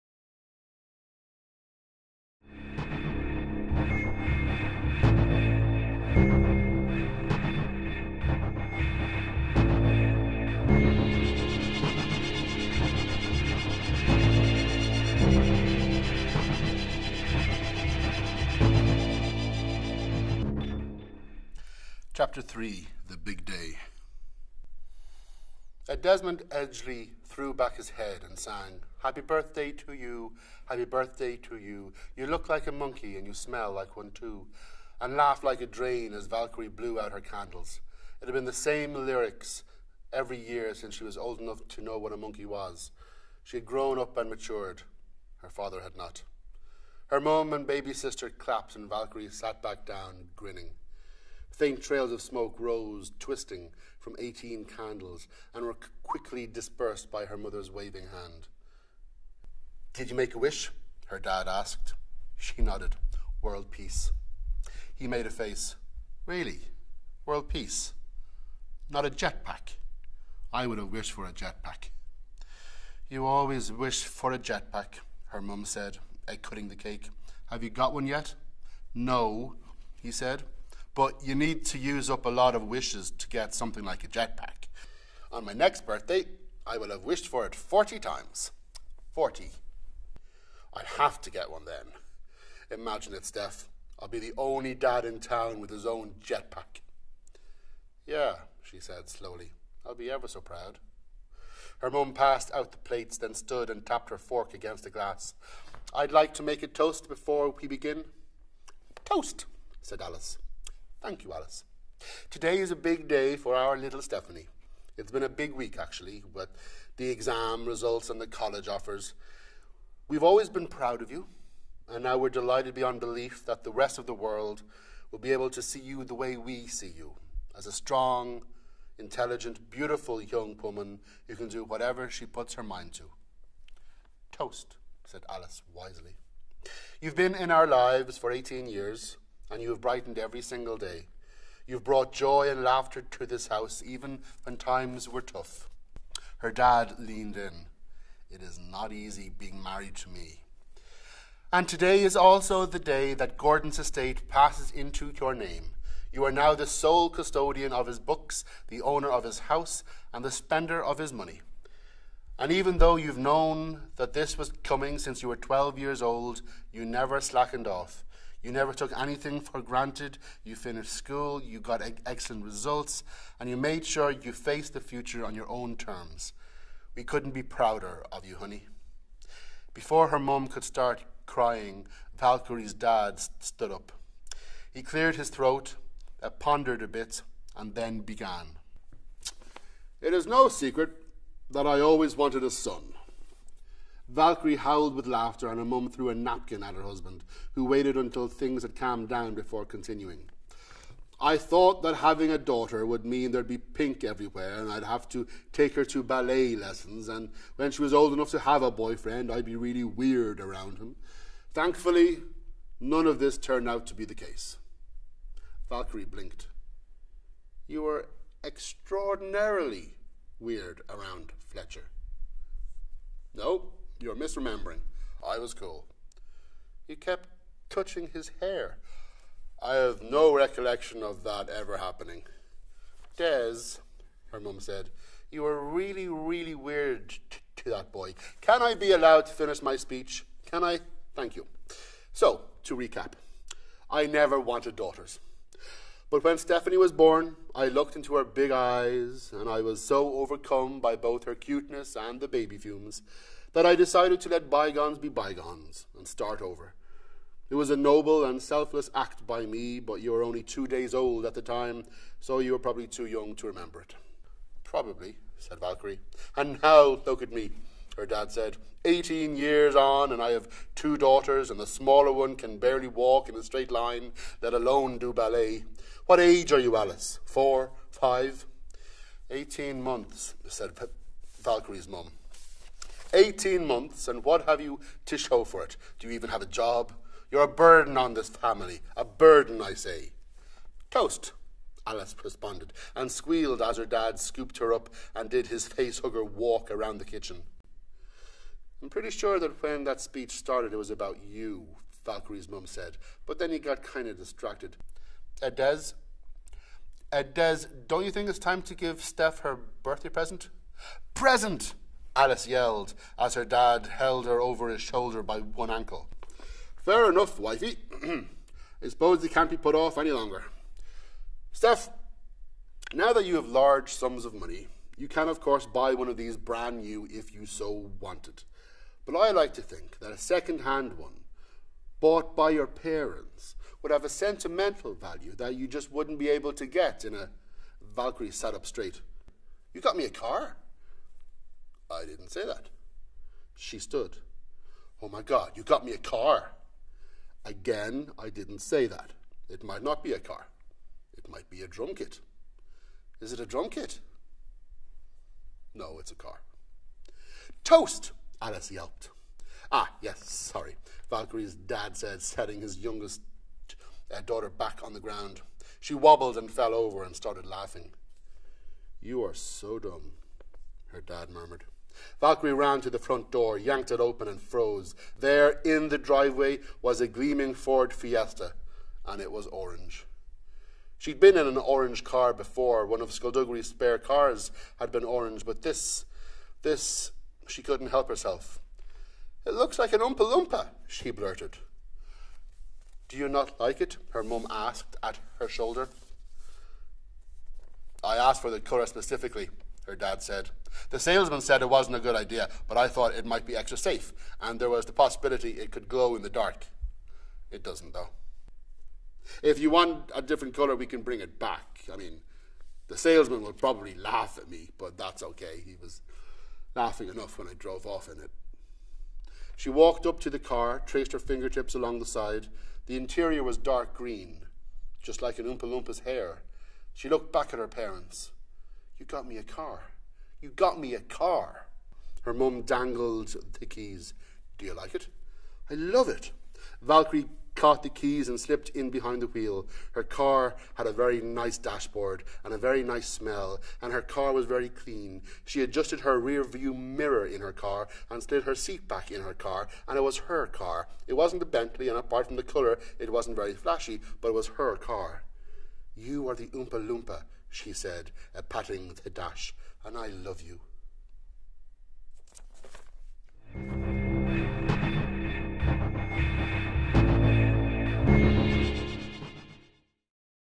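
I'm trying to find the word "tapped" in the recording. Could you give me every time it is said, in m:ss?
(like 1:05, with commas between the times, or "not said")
1:43.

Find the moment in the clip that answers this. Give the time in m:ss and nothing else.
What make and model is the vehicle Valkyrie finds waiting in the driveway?
6:17.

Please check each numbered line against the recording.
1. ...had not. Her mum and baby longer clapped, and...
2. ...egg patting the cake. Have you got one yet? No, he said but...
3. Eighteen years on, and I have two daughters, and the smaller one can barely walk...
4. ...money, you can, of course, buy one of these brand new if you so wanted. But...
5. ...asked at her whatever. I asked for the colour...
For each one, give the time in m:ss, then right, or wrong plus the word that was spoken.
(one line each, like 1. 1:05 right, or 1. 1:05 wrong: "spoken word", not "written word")
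1. 0:45 wrong: "sister", not "longer"
2. 1:16 wrong: "cutting", not "patting"
3. 4:28 right
4. 5:24 right
5. 6:34 wrong: "shoulder", not "whatever".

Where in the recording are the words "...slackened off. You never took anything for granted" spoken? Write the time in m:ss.
2:47.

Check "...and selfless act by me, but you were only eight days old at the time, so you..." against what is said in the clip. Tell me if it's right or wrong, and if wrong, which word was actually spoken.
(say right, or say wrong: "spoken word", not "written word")
wrong: "two", not "eight".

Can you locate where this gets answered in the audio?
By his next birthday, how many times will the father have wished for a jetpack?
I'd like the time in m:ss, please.
1:27.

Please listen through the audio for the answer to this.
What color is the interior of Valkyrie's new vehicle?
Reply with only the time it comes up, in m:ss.
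7:03.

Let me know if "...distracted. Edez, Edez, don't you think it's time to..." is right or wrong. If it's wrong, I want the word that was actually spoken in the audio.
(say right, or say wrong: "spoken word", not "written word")
right.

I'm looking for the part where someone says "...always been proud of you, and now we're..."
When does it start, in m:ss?
2:00.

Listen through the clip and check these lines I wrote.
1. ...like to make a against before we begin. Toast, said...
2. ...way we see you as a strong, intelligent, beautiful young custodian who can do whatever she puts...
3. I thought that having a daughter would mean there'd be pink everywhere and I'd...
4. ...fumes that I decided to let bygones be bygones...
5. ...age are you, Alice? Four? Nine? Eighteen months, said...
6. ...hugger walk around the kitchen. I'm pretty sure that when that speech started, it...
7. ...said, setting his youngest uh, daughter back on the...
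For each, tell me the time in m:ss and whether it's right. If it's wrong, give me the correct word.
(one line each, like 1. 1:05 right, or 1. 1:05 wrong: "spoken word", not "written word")
1. 1:46 wrong: "toast", not "against"
2. 2:06 wrong: "woman", not "custodian"
3. 3:21 right
4. 4:12 right
5. 4:36 wrong: "Five", not "Nine"
6. 4:55 right
7. 6:01 right.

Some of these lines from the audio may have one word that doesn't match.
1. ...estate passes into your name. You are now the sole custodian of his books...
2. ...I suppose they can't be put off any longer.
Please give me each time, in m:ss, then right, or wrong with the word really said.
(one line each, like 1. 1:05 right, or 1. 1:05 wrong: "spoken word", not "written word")
1. 2:33 right
2. 5:18 right.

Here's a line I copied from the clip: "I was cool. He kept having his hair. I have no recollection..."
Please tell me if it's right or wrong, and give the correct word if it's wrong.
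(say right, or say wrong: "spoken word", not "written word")
wrong: "touching", not "having".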